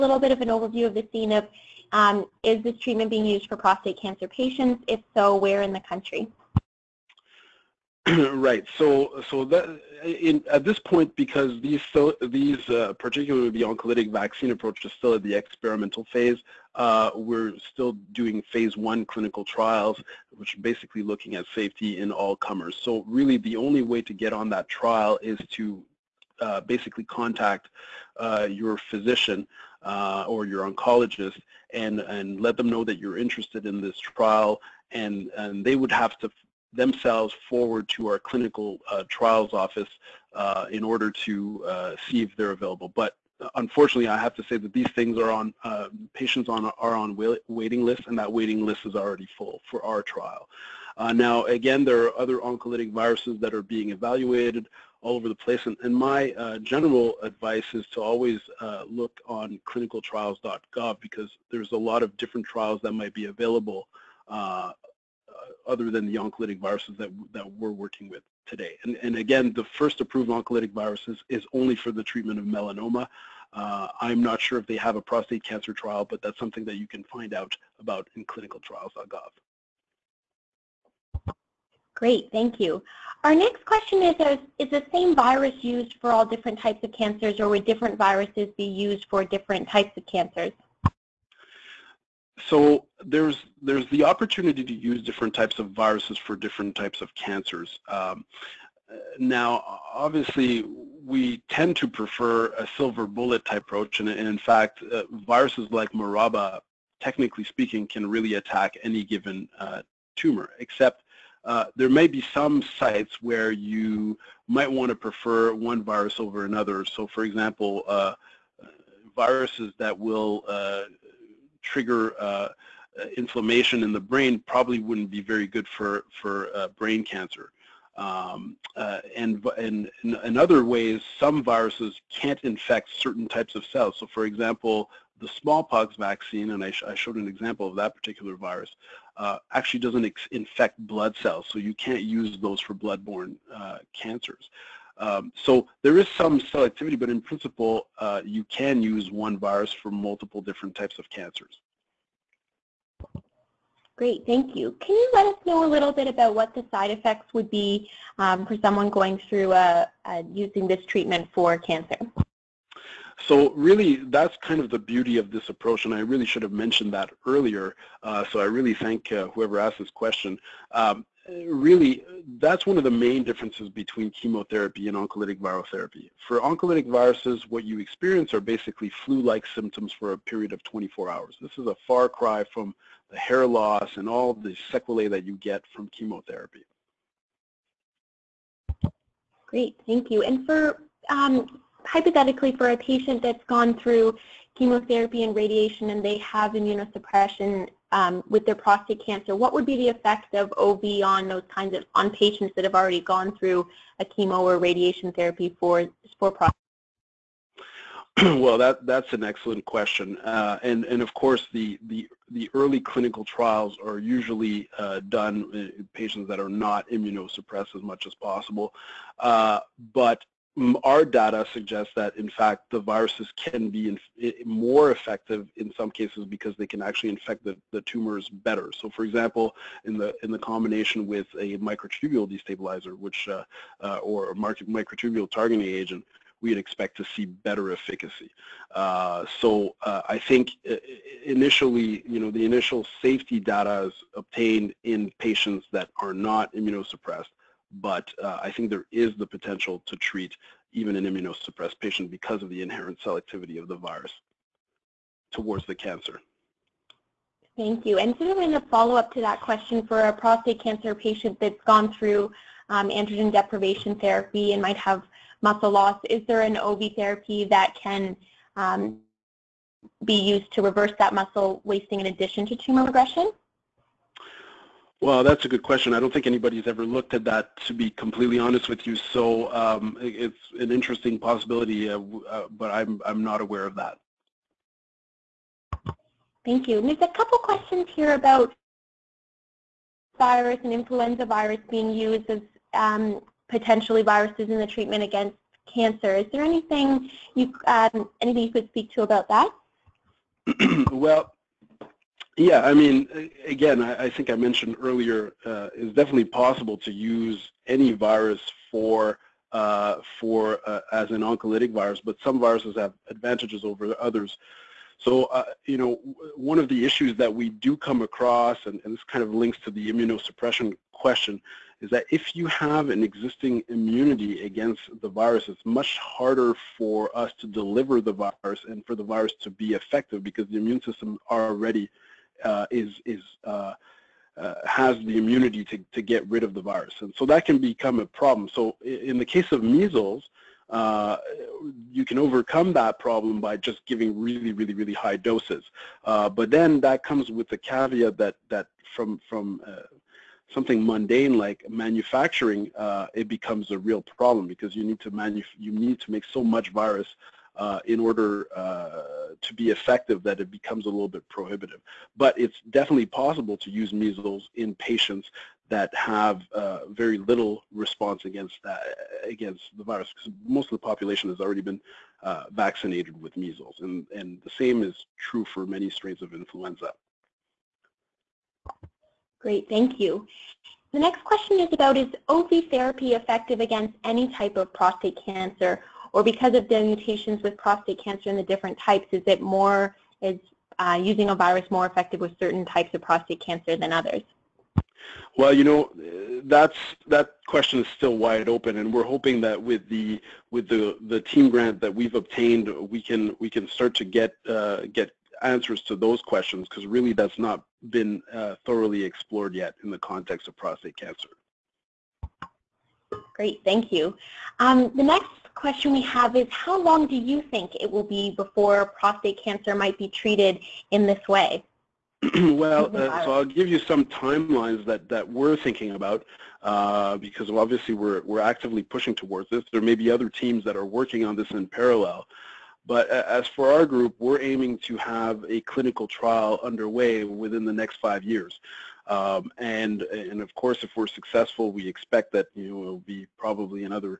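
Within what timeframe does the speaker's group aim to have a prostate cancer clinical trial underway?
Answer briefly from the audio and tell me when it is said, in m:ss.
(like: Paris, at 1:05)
5 years, at 7:18.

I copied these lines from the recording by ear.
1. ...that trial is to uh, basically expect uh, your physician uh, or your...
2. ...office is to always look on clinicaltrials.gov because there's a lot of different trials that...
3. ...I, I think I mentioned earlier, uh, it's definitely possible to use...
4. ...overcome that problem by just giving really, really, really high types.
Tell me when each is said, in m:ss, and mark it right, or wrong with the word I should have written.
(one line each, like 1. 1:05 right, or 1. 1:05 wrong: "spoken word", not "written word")
1. 0:24 wrong: "contact", not "expect"
2. 0:57 wrong: "advice", not "office"
3. 5:03 right
4. 5:42 wrong: "doses", not "types".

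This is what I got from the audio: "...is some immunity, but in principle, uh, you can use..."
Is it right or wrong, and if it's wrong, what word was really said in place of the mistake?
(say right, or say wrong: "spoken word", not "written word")
wrong: "selectivity", not "immunity".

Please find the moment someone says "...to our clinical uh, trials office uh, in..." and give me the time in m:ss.
0:37.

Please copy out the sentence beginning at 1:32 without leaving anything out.
so there's there's the opportunity to use different types of viruses for different types of cancers.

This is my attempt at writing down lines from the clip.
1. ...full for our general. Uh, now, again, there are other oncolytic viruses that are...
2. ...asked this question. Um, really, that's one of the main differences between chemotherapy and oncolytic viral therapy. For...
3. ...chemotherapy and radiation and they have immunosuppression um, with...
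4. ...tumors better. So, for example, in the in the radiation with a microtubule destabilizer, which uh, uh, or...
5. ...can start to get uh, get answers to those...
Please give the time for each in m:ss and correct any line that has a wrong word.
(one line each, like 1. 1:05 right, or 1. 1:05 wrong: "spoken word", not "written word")
1. 0:49 wrong: "trial", not "general"
2. 2:49 right
3. 3:14 right
4. 3:47 wrong: "combination", not "radiation"
5. 6:43 right.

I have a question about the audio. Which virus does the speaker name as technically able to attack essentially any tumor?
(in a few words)
Maraba.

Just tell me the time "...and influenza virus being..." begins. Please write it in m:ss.
4:50.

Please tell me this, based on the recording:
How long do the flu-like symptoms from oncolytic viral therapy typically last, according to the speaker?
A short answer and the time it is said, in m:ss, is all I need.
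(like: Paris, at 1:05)
24 hours, at 3:00.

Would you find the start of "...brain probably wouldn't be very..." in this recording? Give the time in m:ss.
2:04.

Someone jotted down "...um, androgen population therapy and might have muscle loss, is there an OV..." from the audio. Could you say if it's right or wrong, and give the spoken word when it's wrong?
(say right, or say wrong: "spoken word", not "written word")
wrong: "deprivation", not "population".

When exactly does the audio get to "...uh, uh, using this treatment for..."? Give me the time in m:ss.
2:39.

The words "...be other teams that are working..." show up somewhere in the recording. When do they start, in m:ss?
7:09.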